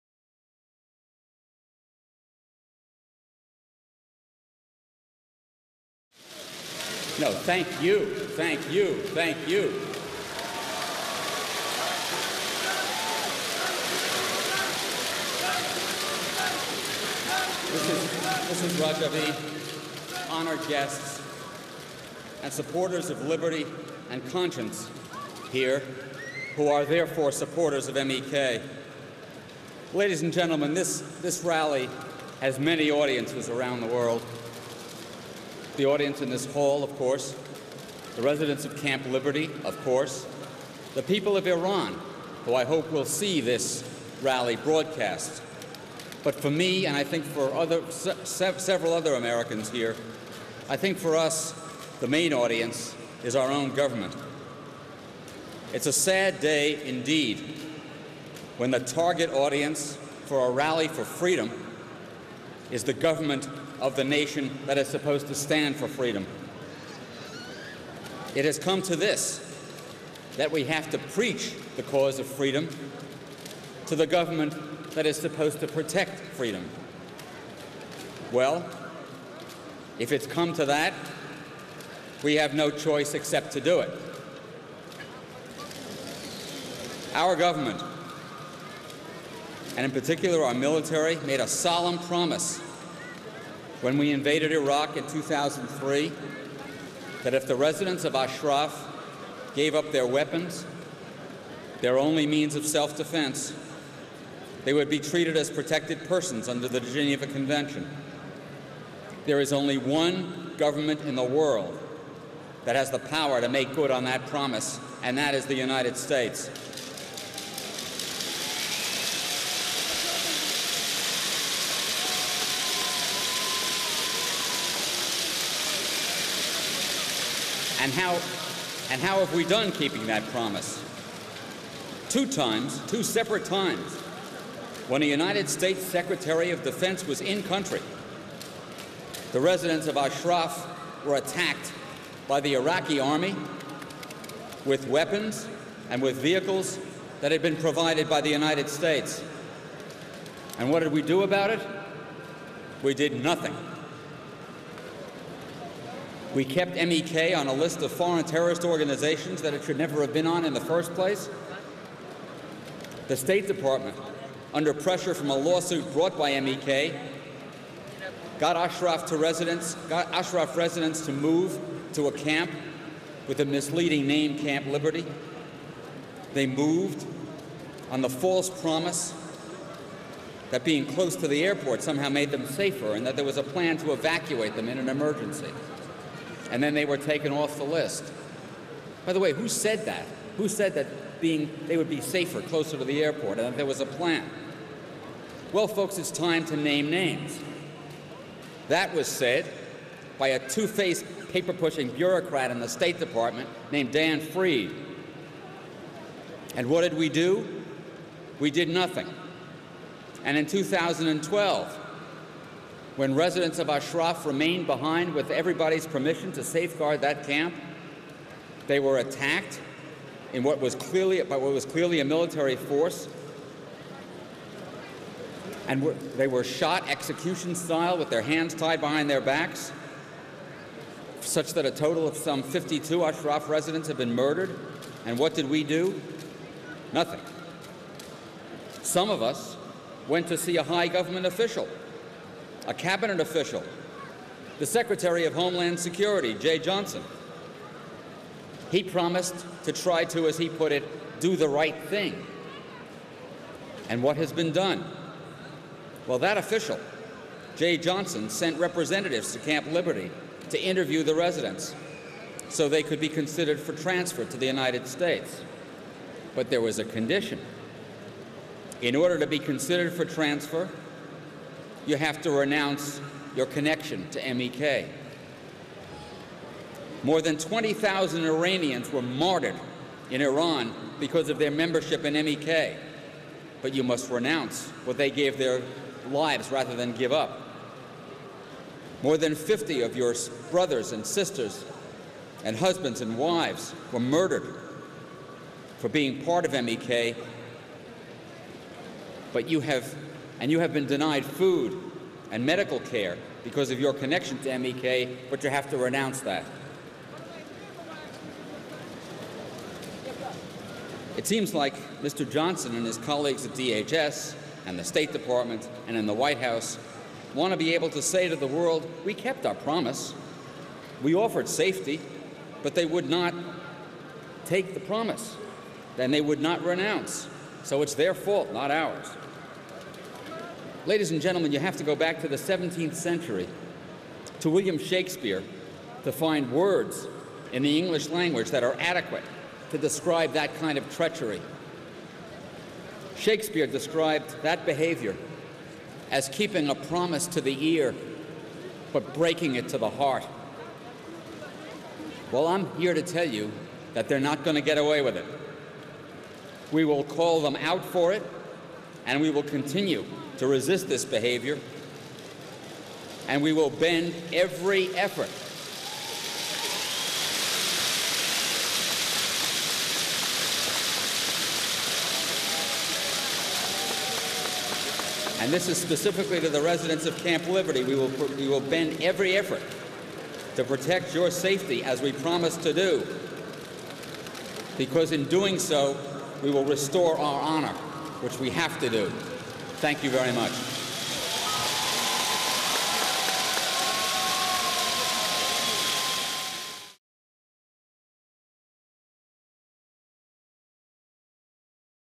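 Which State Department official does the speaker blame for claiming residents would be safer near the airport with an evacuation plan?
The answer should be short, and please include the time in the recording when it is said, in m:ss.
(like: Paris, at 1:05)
Dan Fried, at 3:23.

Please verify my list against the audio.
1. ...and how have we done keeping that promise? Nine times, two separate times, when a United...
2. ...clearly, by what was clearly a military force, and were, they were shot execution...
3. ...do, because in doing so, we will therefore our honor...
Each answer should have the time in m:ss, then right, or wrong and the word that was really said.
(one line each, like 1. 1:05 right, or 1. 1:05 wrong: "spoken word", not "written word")
1. 2:08 wrong: "Two", not "Nine"
2. 3:40 right
3. 6:22 wrong: "restore", not "therefore".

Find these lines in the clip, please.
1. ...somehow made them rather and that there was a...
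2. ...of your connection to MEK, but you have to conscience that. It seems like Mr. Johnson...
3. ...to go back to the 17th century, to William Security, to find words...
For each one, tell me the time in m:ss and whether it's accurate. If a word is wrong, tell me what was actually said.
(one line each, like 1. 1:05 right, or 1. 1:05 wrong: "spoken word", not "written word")
1. 3:01 wrong: "safer", not "rather"
2. 5:03 wrong: "renounce", not "conscience"
3. 5:31 wrong: "Shakespeare", not "Security".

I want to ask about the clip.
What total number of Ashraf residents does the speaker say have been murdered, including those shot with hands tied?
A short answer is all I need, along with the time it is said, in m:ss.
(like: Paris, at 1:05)
52, at 3:52.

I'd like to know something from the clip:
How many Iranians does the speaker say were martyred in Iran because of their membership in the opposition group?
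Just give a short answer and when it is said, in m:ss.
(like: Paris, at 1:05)
More than 20,000, at 4:37.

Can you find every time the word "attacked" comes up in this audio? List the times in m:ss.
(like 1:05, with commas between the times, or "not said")
2:21, 3:38.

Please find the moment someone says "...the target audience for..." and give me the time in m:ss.
0:58.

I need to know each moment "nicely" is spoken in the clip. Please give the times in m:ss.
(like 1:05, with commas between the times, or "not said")
not said.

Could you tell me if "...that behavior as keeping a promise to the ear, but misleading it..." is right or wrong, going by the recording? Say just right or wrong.
wrong.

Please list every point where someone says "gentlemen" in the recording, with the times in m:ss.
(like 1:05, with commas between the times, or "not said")
0:30, 5:31.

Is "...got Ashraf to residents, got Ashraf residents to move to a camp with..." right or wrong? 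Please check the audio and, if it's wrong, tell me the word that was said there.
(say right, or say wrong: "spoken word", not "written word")
right.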